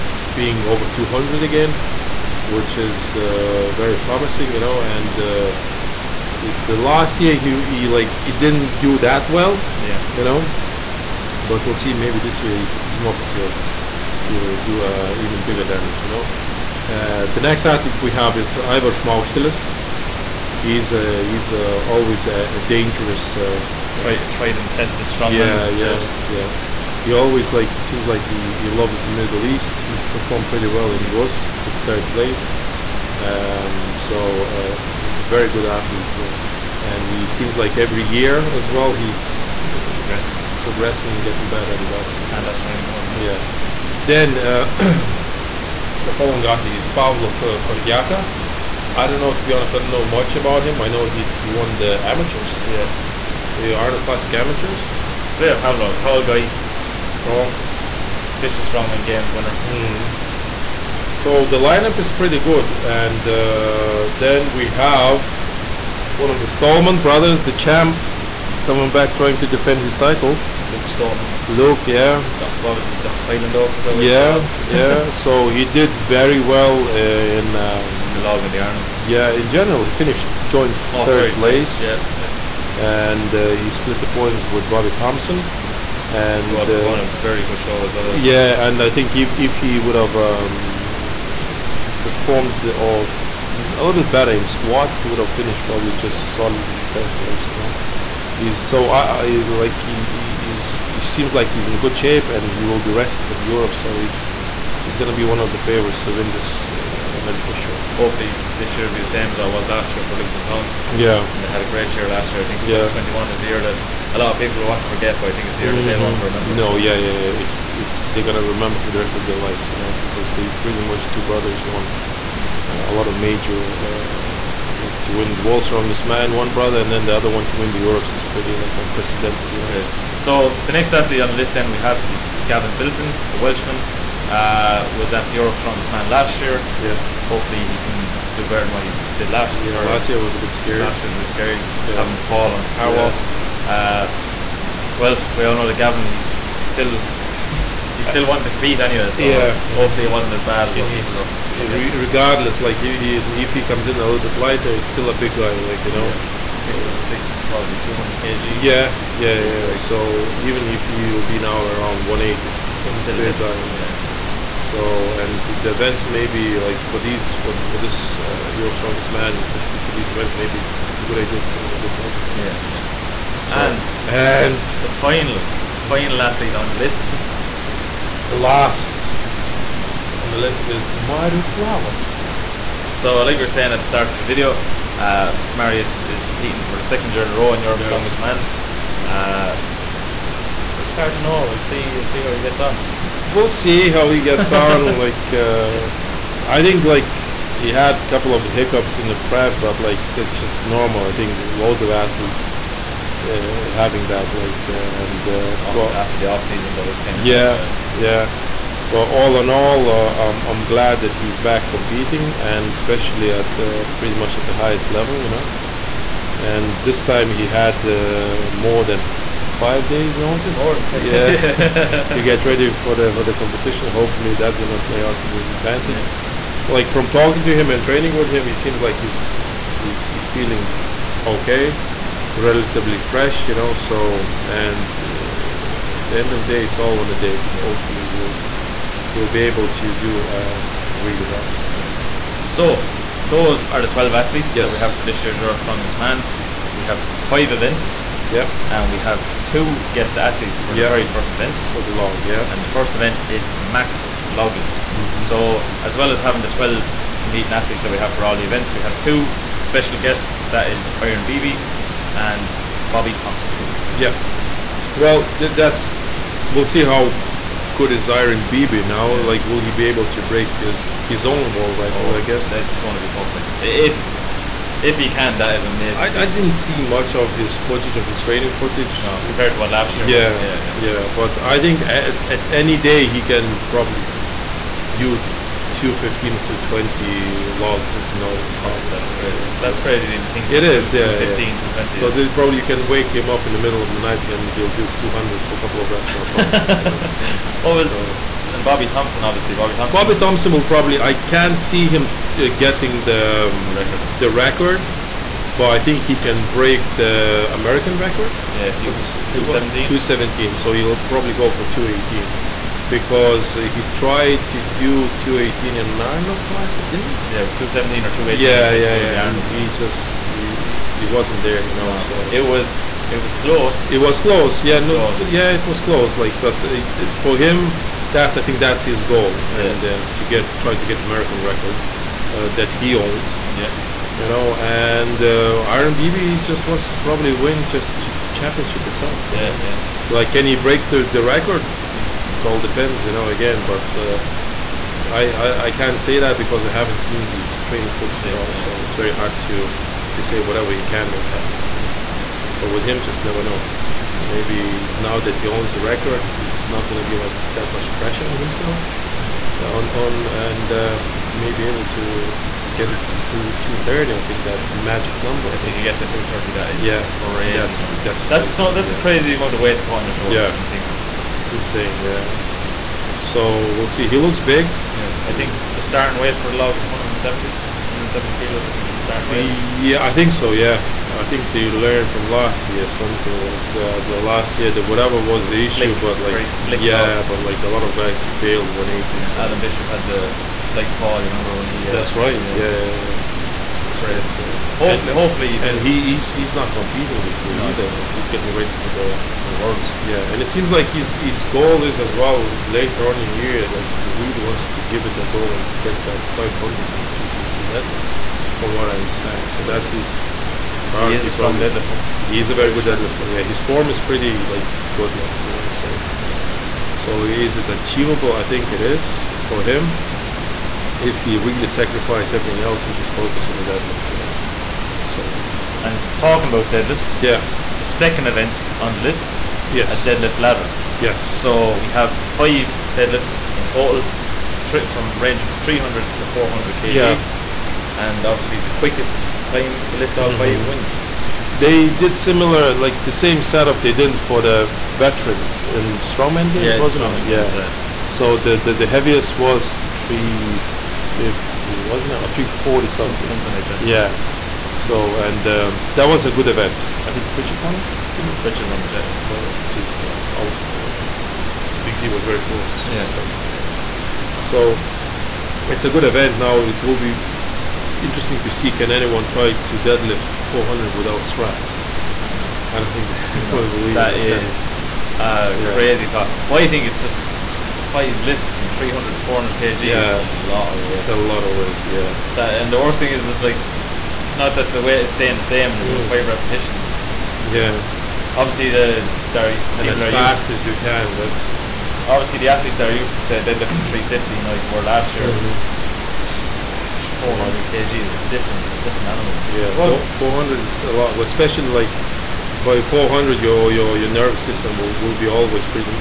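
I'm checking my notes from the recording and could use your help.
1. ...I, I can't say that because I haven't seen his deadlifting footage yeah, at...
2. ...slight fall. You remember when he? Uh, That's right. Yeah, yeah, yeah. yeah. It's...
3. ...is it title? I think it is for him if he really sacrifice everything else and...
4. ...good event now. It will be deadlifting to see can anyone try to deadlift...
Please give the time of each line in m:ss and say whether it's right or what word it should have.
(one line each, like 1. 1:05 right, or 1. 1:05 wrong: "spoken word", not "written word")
1. 5:45 wrong: "training", not "deadlifting"
2. 6:30 right
3. 6:57 wrong: "achievable", not "title"
4. 7:45 wrong: "interesting", not "deadlifting".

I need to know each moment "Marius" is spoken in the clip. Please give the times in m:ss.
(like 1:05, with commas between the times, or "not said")
3:00, 3:05.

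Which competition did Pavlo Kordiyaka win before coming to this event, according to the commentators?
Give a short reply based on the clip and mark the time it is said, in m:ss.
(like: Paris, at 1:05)
Arnold Classic Amateurs, at 0:53.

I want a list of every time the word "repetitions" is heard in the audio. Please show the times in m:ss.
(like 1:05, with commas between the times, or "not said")
8:06.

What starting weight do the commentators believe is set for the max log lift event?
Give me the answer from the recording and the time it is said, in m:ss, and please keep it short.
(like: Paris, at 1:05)
170 kg, at 6:17.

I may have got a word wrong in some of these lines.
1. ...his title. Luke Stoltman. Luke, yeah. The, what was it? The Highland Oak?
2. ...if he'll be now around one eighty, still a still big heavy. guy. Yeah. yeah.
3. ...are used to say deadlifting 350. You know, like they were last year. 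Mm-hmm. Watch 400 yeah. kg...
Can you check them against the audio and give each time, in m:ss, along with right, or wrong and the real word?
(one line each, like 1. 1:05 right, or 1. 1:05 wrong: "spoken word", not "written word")
1. 1:09 right
2. 2:40 right
3. 8:12 right.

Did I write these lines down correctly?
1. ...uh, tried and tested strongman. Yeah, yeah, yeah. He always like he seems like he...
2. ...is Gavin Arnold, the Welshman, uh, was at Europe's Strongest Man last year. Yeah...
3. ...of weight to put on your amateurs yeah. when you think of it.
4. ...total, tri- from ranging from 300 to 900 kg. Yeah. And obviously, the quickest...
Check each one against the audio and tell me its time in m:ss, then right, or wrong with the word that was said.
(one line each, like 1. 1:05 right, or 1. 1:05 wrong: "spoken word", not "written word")
1. 0:24 right
2. 2:12 wrong: "Bilton", not "Arnold"
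3. 6:09 wrong: "shoulders", not "amateurs"
4. 7:13 wrong: "400", not "900".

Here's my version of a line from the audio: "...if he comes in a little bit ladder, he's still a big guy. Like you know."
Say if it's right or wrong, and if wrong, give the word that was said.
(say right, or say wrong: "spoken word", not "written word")
wrong: "lighter", not "ladder".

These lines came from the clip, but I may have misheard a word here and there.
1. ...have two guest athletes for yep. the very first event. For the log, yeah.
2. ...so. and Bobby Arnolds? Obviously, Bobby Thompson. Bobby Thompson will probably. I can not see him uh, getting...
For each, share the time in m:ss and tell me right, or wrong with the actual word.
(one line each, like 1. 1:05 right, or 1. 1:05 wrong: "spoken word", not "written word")
1. 4:08 right
2. 4:58 wrong: "Thompson", not "Arnolds".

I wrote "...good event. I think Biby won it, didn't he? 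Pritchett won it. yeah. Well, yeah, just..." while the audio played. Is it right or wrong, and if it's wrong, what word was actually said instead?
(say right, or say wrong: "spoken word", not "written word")
wrong: "Pritchett", not "Biby".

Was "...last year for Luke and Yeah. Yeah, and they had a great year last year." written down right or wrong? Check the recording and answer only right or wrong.
wrong.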